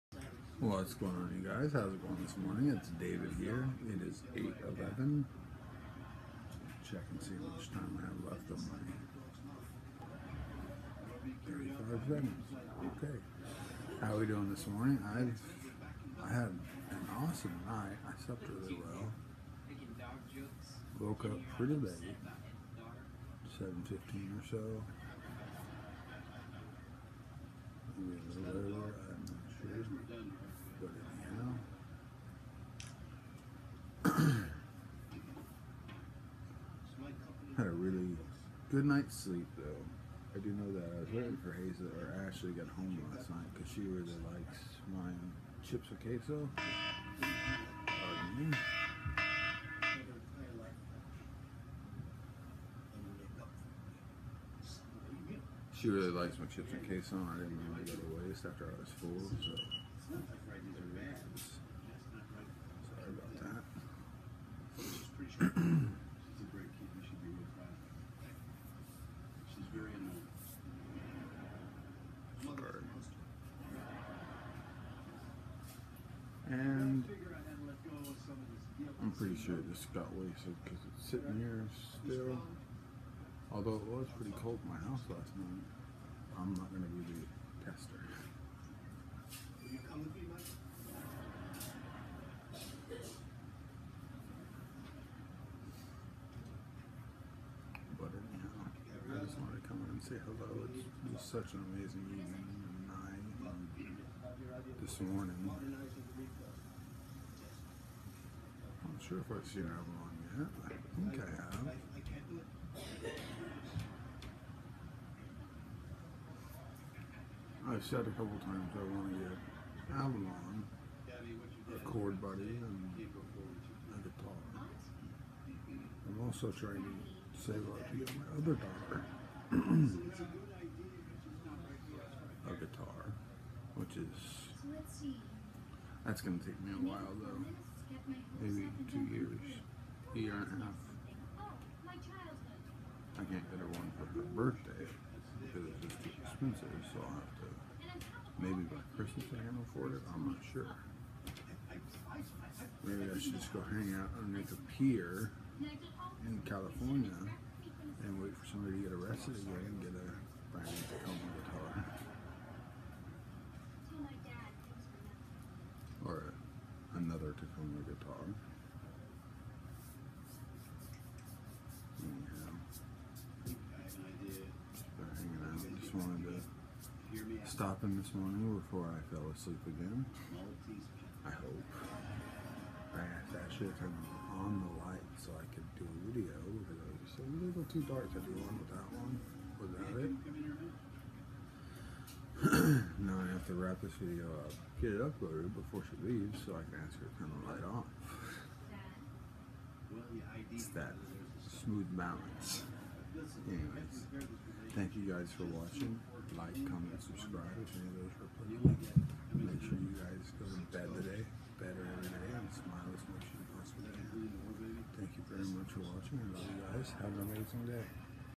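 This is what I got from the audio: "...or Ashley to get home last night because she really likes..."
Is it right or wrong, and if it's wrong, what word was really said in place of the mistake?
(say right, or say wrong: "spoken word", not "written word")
right.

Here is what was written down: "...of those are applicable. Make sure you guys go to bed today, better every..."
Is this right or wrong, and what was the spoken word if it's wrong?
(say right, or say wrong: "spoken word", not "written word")
right.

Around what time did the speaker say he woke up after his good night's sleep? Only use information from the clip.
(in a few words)
7:15.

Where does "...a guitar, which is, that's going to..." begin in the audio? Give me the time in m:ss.
2:12.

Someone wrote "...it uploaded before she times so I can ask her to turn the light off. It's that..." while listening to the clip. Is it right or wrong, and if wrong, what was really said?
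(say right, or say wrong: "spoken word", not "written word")
wrong: "leaves", not "times".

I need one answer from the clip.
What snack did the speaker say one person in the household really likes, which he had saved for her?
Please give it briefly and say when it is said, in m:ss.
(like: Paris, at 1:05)
chips and queso, at 0:56.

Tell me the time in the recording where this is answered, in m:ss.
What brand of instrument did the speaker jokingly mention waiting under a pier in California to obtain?
2:47.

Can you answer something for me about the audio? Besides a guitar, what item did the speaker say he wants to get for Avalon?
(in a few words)
a chord buddy.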